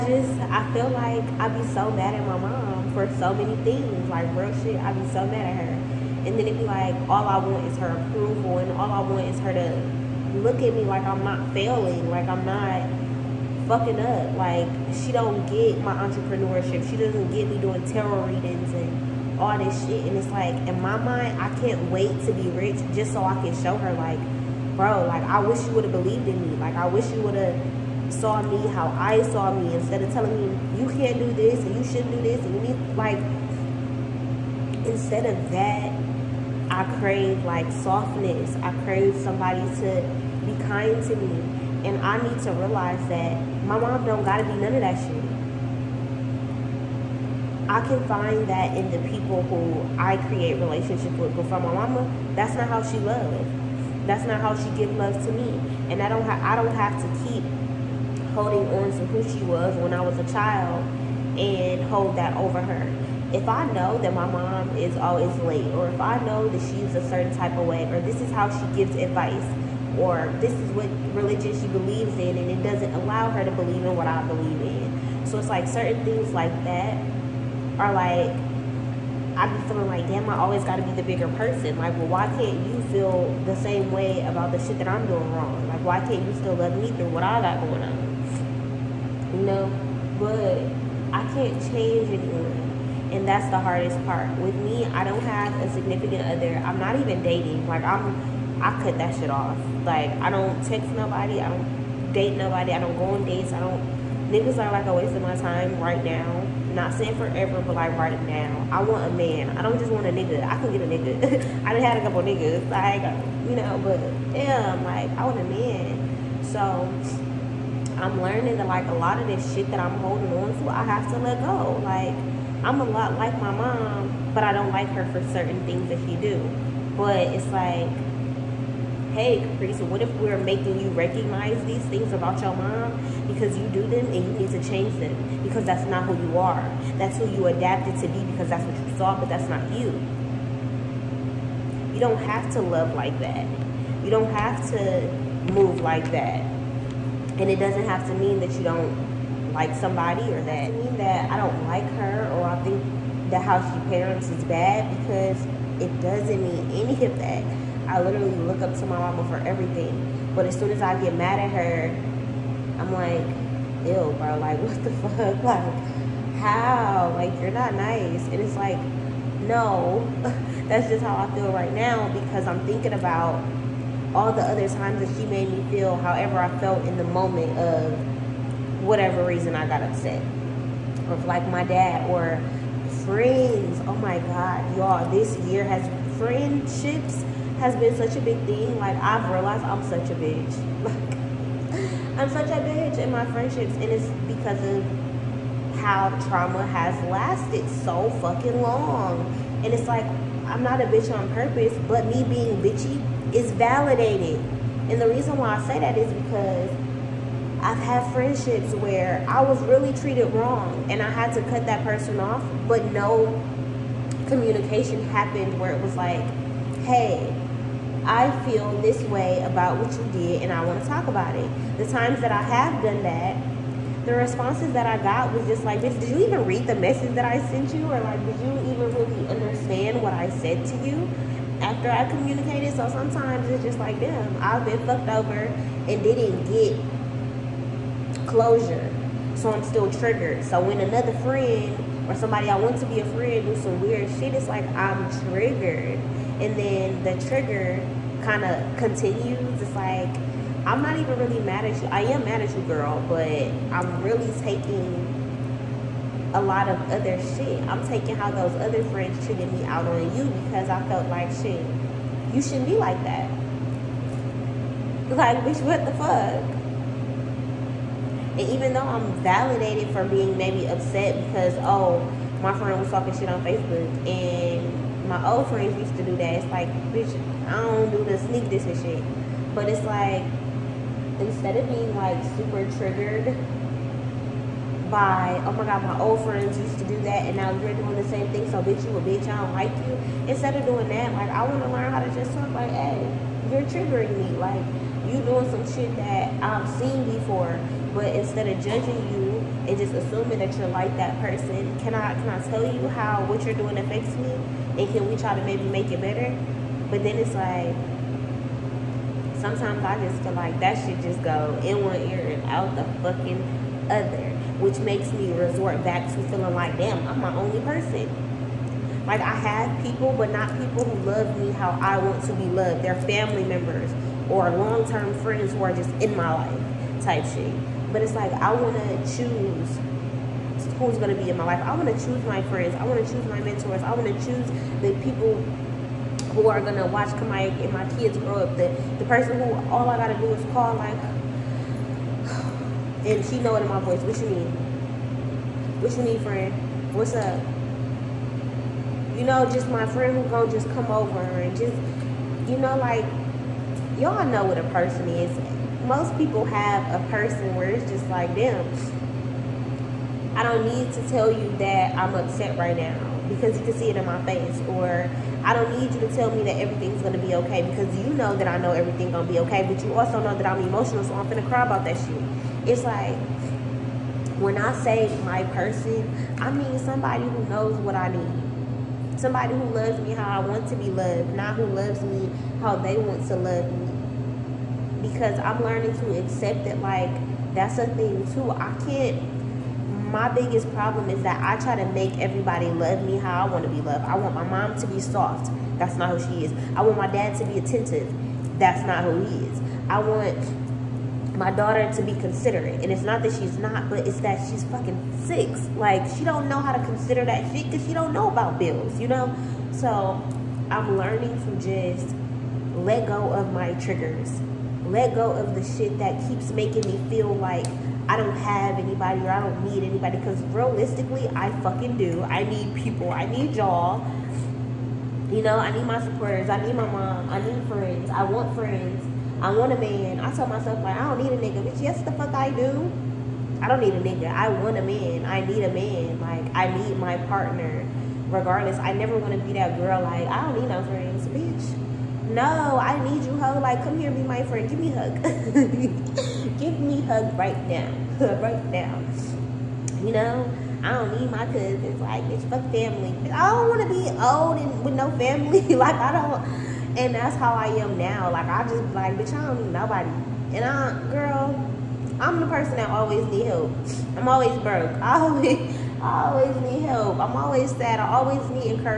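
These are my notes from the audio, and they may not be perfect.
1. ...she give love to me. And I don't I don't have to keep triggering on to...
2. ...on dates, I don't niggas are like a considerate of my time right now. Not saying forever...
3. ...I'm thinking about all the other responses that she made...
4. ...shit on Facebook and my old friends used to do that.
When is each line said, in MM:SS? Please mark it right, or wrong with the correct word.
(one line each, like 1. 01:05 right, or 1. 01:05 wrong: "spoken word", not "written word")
1. 00:54 wrong: "holding", not "triggering"
2. 01:43 wrong: "waste", not "considerate"
3. 02:52 wrong: "times", not "responses"
4. 04:33 right.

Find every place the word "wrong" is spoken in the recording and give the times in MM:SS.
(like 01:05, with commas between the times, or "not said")
01:25, 03:30.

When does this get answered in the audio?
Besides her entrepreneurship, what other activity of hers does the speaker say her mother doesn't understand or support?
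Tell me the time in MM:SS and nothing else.
00:17.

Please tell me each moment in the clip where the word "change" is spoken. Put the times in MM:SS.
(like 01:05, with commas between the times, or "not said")
01:31, 02:14.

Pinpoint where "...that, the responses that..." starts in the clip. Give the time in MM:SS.
03:43.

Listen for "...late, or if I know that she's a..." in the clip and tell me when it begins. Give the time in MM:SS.
01:05.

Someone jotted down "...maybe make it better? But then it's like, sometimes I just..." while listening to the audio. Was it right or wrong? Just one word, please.
right.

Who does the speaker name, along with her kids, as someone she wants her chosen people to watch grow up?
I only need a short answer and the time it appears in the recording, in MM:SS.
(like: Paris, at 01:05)
Kamaik, at 05:37.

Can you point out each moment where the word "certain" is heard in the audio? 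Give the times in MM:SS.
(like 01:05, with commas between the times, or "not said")
01:07, 01:15, 02:05.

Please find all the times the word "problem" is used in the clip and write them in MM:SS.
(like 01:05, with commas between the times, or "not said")
06:30.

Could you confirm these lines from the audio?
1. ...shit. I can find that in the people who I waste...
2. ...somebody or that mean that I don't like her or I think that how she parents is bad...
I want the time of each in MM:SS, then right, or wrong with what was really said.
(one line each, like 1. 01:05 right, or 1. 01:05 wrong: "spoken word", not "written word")
1. 00:44 wrong: "create", not "waste"
2. 02:29 right.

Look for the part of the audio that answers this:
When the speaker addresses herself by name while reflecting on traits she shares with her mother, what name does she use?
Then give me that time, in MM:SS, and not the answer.
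02:09.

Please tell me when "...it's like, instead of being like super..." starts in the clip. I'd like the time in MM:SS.
04:39.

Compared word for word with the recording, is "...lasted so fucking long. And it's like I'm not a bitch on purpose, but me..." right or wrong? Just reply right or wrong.
right.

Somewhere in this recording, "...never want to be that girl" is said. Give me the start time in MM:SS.
07:18.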